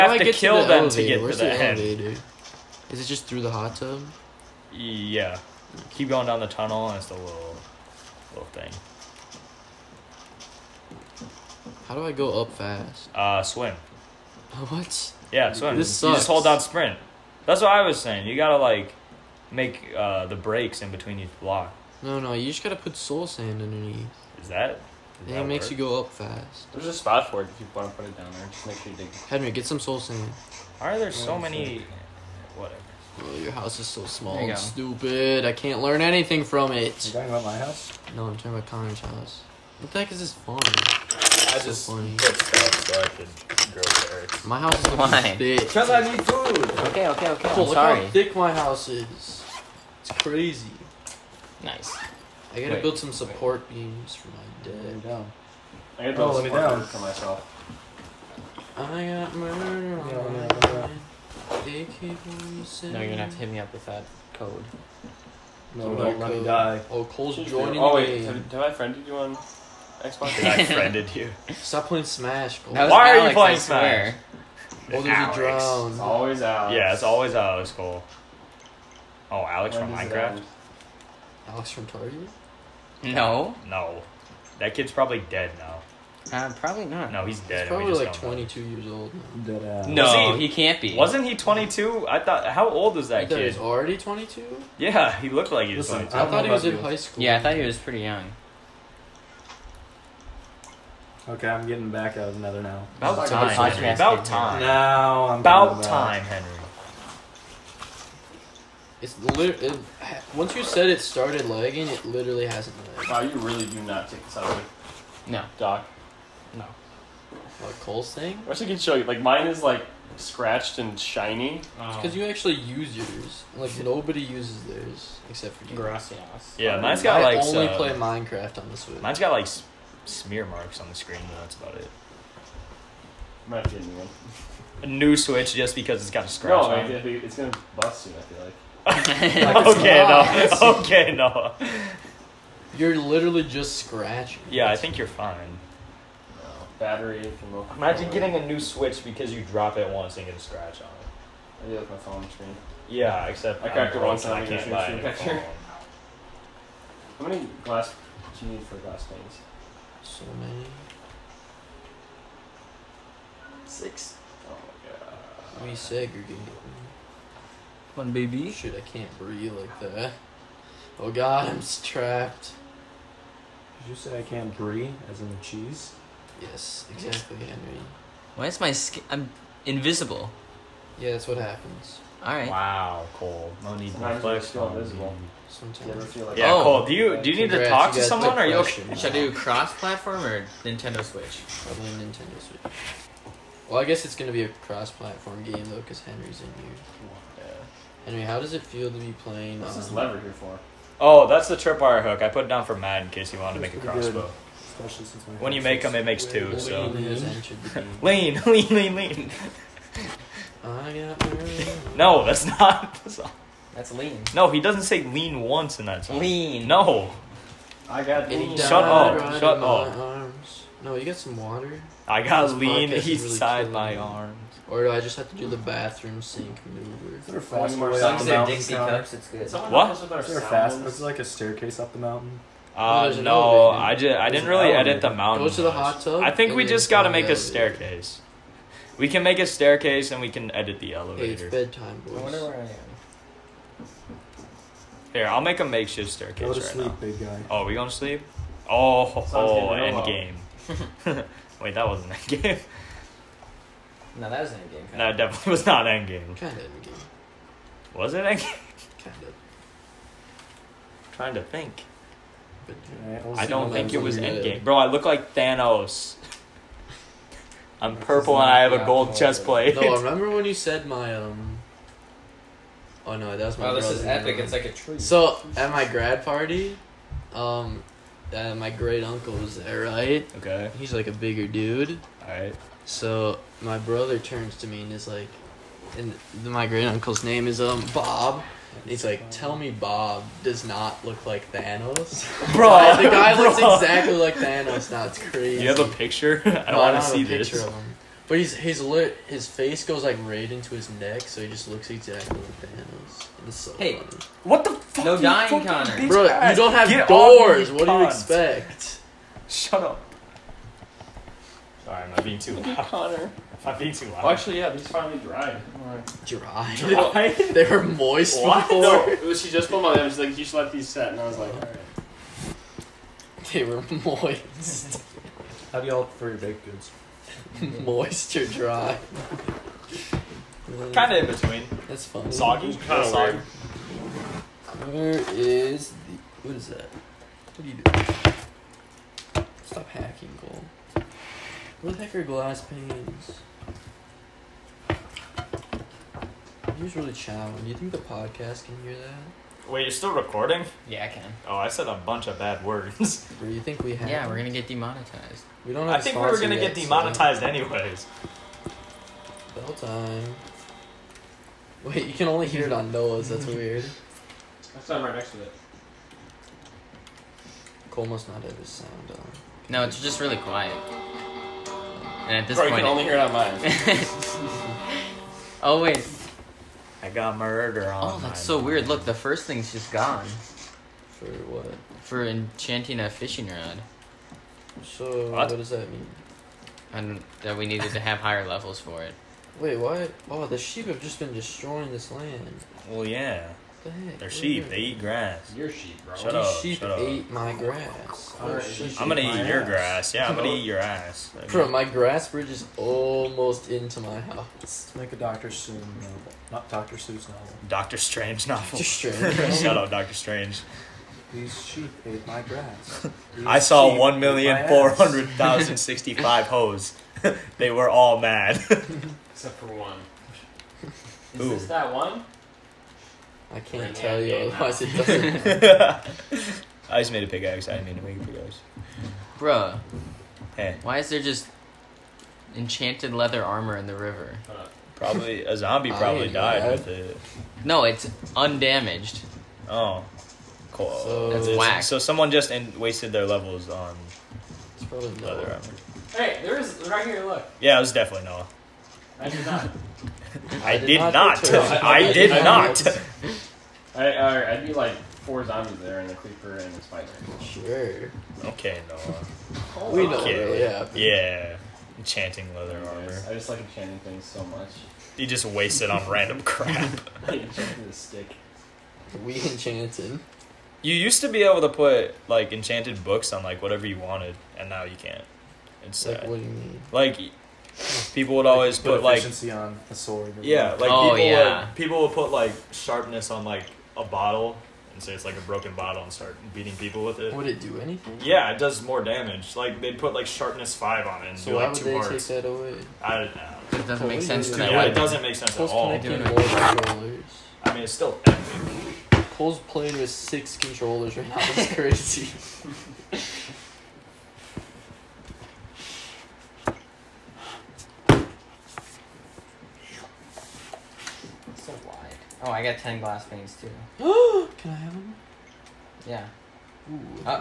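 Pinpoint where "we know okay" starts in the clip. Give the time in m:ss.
7:39.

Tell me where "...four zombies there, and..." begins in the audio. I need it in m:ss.
7:35.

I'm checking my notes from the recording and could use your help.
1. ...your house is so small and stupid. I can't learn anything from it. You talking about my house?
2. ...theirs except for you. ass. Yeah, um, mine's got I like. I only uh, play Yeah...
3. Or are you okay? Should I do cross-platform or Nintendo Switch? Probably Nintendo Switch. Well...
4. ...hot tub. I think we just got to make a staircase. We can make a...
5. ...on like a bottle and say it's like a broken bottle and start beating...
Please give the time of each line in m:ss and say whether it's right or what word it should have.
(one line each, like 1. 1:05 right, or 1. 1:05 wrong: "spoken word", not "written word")
1. 0:33 right
2. 2:04 wrong: "Minecraft", not "Yeah"
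3. 3:08 right
4. 3:55 right
5. 8:03 right.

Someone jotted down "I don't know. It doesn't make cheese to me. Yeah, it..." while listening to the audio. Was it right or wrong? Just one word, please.
wrong.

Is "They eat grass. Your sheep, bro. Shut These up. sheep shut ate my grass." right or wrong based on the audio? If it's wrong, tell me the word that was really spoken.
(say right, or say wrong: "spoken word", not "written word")
right.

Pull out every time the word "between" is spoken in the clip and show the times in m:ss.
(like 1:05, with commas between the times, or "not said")
0:20, 5:31.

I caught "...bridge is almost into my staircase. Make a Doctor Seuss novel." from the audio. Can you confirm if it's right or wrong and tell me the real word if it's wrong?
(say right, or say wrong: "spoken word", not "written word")
wrong: "house", not "staircase".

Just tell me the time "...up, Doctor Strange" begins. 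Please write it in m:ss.
6:49.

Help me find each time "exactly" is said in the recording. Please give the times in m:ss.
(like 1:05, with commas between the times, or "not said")
2:56, 4:53, 5:01.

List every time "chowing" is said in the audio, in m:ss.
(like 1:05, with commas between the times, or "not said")
5:47.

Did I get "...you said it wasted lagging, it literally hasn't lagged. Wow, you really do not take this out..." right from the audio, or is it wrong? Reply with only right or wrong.
wrong.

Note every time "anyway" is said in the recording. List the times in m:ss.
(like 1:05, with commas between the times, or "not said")
3:18, 5:57.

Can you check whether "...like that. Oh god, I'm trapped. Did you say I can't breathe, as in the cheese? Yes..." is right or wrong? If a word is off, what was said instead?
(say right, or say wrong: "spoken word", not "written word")
right.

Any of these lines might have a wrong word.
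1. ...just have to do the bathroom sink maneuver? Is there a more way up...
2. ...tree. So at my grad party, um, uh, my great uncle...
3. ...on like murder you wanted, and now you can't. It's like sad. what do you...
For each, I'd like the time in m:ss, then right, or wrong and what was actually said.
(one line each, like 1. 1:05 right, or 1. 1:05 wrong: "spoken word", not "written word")
1. 3:45 right
2. 4:34 right
3. 7:53 wrong: "whatever", not "murder".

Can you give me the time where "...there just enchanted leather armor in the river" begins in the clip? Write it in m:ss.
7:11.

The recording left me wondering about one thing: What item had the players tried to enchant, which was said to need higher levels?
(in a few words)
fishing rod.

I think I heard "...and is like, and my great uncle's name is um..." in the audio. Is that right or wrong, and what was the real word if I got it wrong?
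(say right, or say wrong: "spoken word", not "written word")
right.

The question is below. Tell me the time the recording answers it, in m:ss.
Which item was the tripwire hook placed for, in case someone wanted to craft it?
3:23.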